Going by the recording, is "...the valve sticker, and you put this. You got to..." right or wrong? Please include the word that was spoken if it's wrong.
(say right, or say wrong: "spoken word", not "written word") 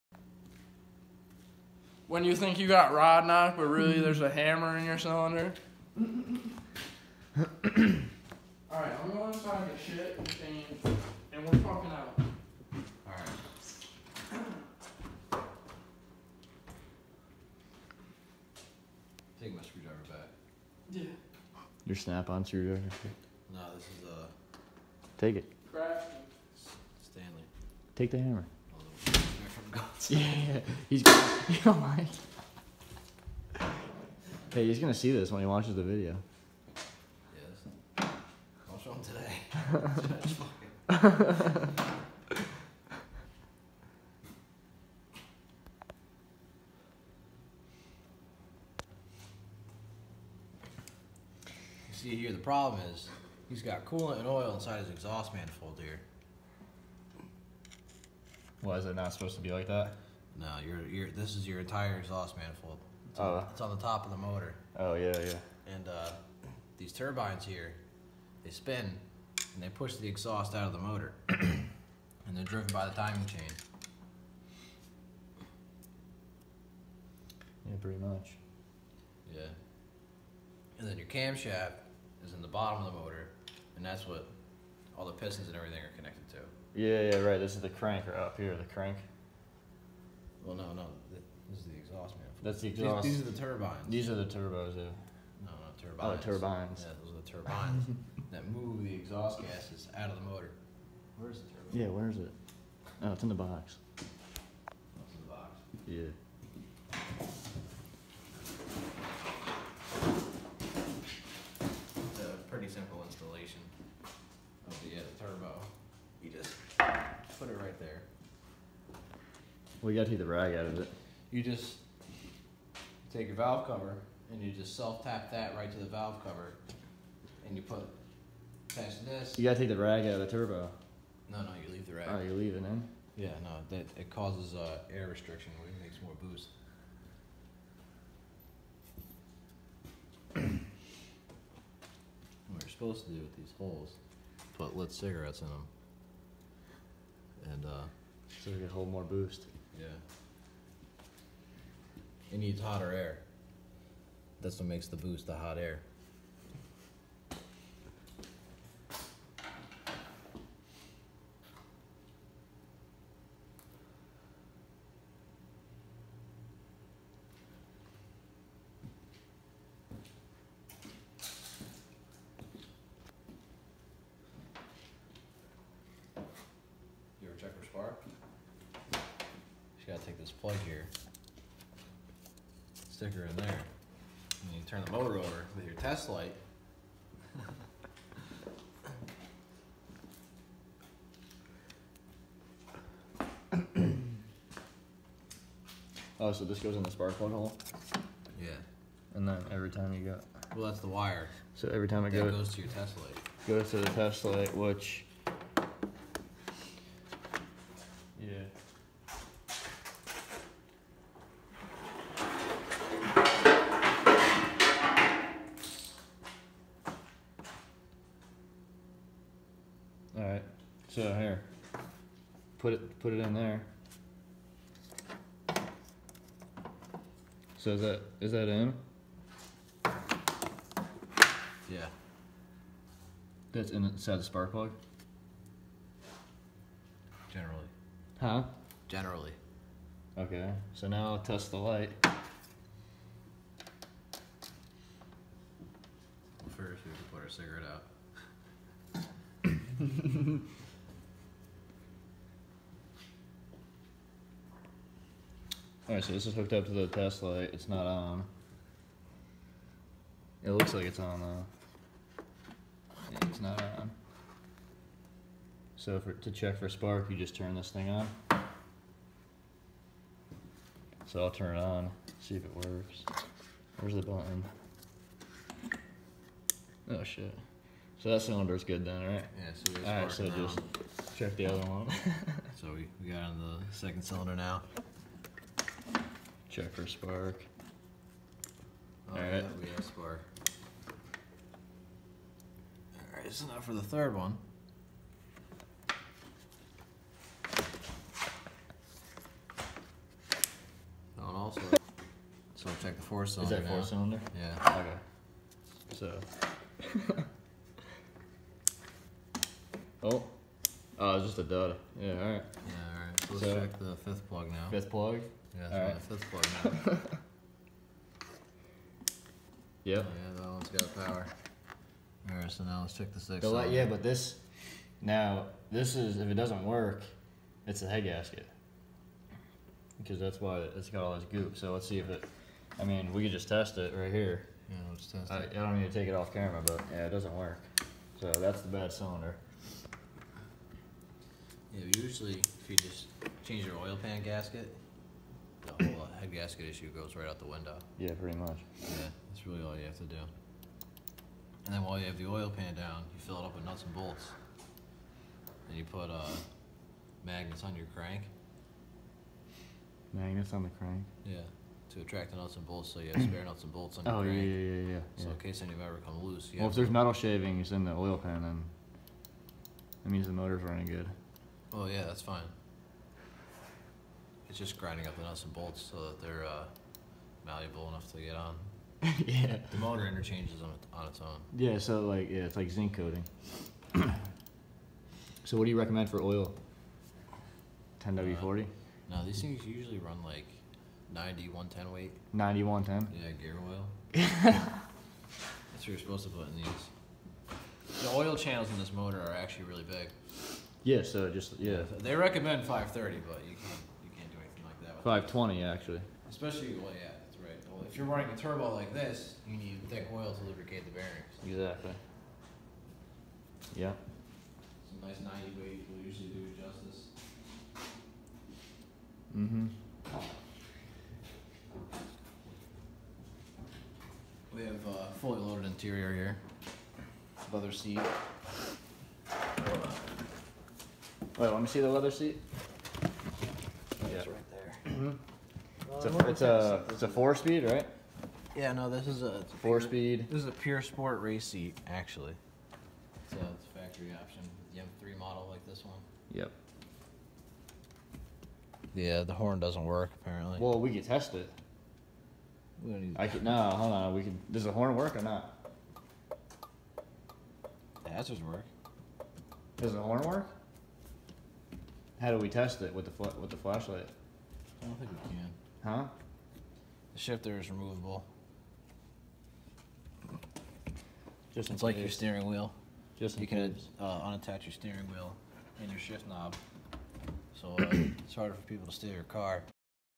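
wrong: "cover", not "sticker".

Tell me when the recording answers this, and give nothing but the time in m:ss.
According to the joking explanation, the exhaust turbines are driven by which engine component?
1:12.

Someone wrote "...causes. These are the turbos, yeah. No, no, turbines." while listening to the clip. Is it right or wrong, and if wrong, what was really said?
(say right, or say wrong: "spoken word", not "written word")
wrong: "turbines", not "causes".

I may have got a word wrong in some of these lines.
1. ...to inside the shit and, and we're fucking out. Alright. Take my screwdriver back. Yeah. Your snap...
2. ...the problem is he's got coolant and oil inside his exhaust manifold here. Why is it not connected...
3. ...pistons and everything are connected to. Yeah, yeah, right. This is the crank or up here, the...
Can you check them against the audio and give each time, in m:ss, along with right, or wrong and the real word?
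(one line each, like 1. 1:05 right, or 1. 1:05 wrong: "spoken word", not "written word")
1. 0:09 right
2. 0:52 wrong: "supposed", not "connected"
3. 1:25 right.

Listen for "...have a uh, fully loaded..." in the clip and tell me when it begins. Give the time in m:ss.
7:04.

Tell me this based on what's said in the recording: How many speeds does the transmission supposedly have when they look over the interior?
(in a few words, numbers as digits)
4.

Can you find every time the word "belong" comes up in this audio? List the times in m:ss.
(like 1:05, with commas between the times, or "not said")
not said.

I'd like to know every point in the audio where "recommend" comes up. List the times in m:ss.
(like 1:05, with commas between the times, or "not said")
6:25, 6:42.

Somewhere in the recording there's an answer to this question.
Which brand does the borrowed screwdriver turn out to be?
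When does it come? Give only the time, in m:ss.
0:27.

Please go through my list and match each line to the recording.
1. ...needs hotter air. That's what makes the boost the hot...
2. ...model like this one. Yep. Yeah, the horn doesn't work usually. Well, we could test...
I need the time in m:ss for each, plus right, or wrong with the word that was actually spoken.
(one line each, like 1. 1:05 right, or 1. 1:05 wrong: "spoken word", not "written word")
1. 2:32 right
2. 7:25 wrong: "apparently", not "usually".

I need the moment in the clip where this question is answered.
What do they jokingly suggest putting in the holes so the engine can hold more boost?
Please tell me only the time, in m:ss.
2:24.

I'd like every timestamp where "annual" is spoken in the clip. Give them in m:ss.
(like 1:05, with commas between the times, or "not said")
not said.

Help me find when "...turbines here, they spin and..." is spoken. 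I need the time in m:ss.
1:06.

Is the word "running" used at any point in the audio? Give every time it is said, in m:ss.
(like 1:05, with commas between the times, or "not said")
6:10, 6:48.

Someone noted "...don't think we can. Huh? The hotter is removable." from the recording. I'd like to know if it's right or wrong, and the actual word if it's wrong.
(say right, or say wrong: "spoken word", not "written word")
wrong: "shifter", not "hotter".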